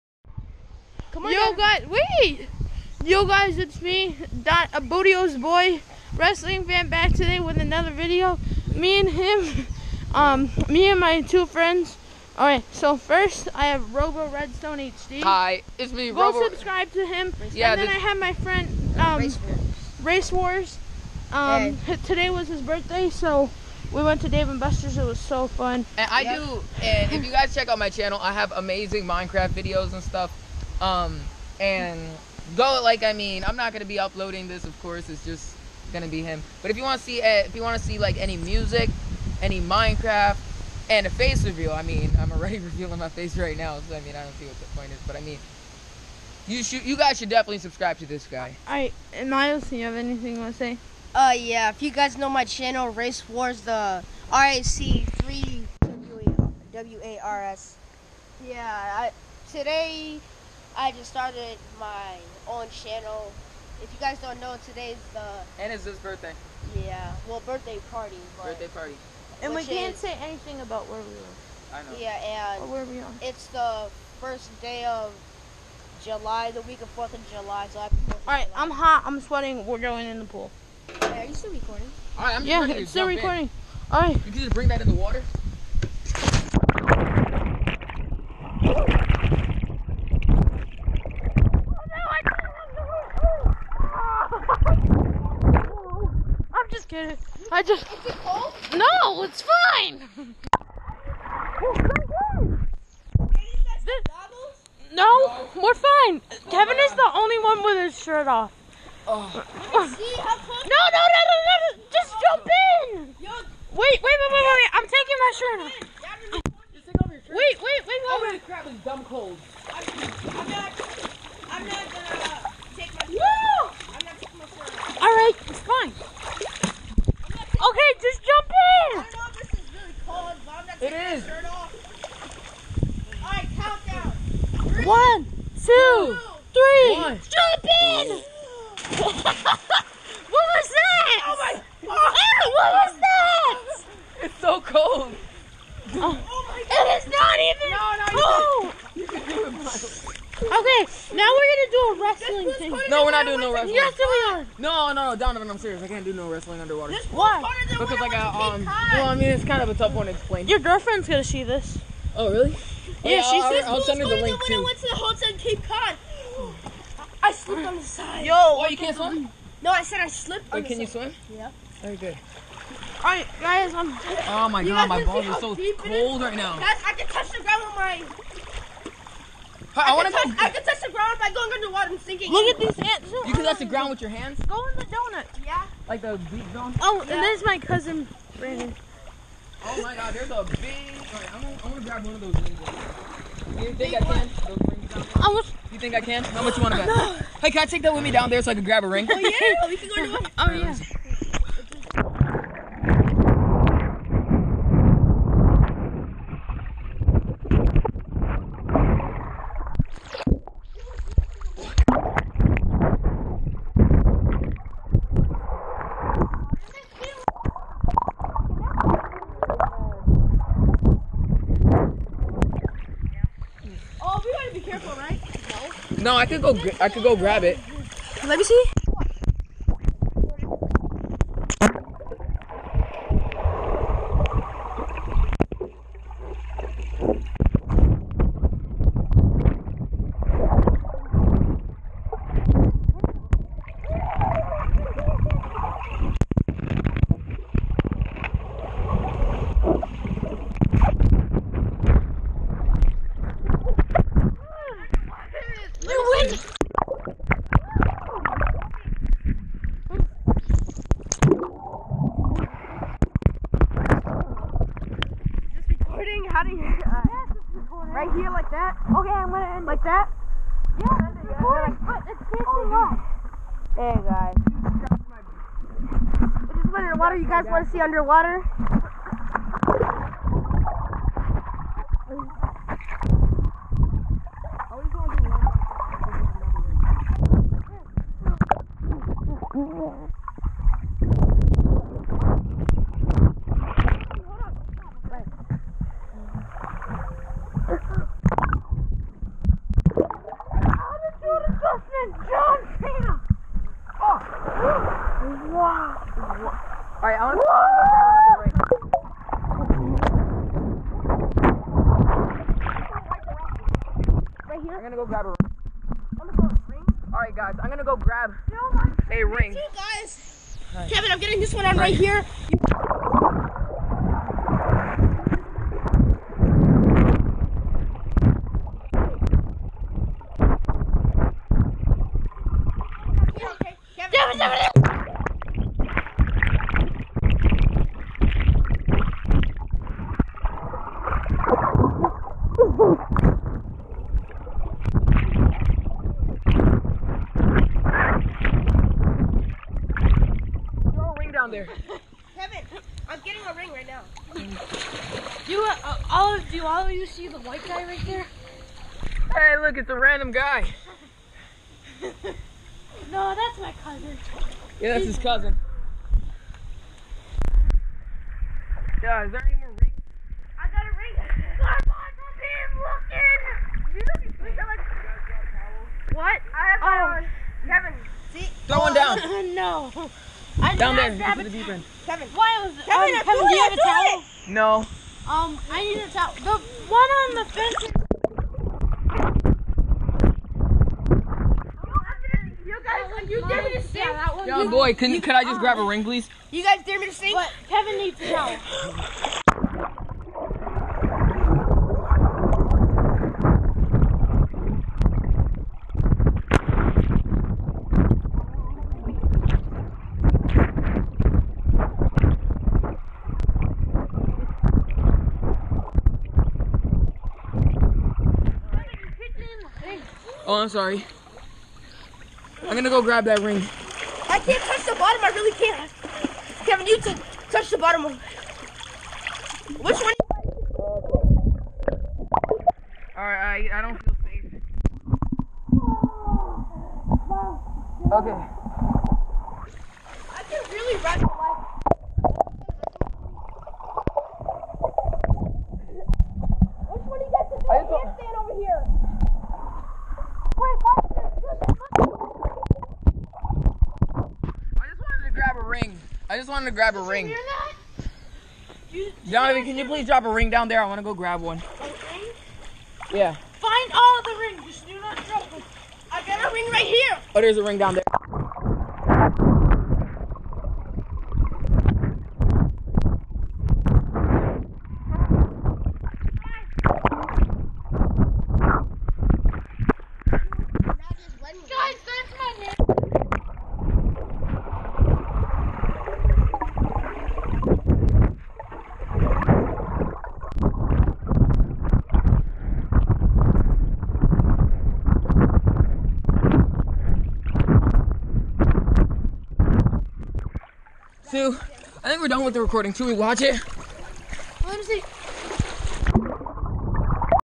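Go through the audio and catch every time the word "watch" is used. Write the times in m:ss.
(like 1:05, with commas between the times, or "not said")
8:23.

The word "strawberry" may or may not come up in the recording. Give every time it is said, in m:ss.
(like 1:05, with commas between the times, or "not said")
not said.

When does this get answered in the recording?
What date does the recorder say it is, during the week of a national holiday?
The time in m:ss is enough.
1:14.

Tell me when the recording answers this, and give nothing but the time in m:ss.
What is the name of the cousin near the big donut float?
3:08.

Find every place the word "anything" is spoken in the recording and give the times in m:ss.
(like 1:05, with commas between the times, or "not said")
0:49, 1:10.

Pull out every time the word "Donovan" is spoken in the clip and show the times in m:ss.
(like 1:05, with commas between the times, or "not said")
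2:35, 7:39.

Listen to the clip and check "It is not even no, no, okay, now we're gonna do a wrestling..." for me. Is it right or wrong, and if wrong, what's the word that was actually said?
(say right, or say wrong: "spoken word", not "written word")
right.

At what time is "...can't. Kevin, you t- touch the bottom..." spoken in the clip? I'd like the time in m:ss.
7:05.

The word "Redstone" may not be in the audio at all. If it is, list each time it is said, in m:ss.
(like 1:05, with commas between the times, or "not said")
0:14.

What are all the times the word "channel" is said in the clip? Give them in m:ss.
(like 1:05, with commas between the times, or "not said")
0:27, 0:52, 1:02.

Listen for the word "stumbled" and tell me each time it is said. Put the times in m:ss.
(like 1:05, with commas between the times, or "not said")
not said.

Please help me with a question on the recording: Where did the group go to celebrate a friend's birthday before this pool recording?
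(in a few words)
Dave and Buster's.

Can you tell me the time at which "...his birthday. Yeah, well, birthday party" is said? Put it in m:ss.
1:05.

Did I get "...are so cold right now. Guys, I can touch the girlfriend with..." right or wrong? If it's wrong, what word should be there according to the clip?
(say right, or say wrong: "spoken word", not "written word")
wrong: "ground", not "girlfriend".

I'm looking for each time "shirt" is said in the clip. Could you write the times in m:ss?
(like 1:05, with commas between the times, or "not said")
1:48.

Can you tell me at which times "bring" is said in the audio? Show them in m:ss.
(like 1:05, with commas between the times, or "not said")
1:24.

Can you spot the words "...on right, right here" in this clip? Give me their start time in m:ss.
5:21.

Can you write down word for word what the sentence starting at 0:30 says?
Um, and go like I mean, I'm not gonna be uploading this, of course.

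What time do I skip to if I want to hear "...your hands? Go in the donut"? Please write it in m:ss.
3:04.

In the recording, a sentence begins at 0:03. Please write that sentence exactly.
Yo guys, it's me, Dot Bootyo's boy, wrestling fan, back today with another video.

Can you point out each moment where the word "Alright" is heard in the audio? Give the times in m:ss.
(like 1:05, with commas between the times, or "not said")
2:53, 7:13.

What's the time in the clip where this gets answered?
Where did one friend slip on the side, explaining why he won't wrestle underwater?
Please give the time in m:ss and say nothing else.
2:45.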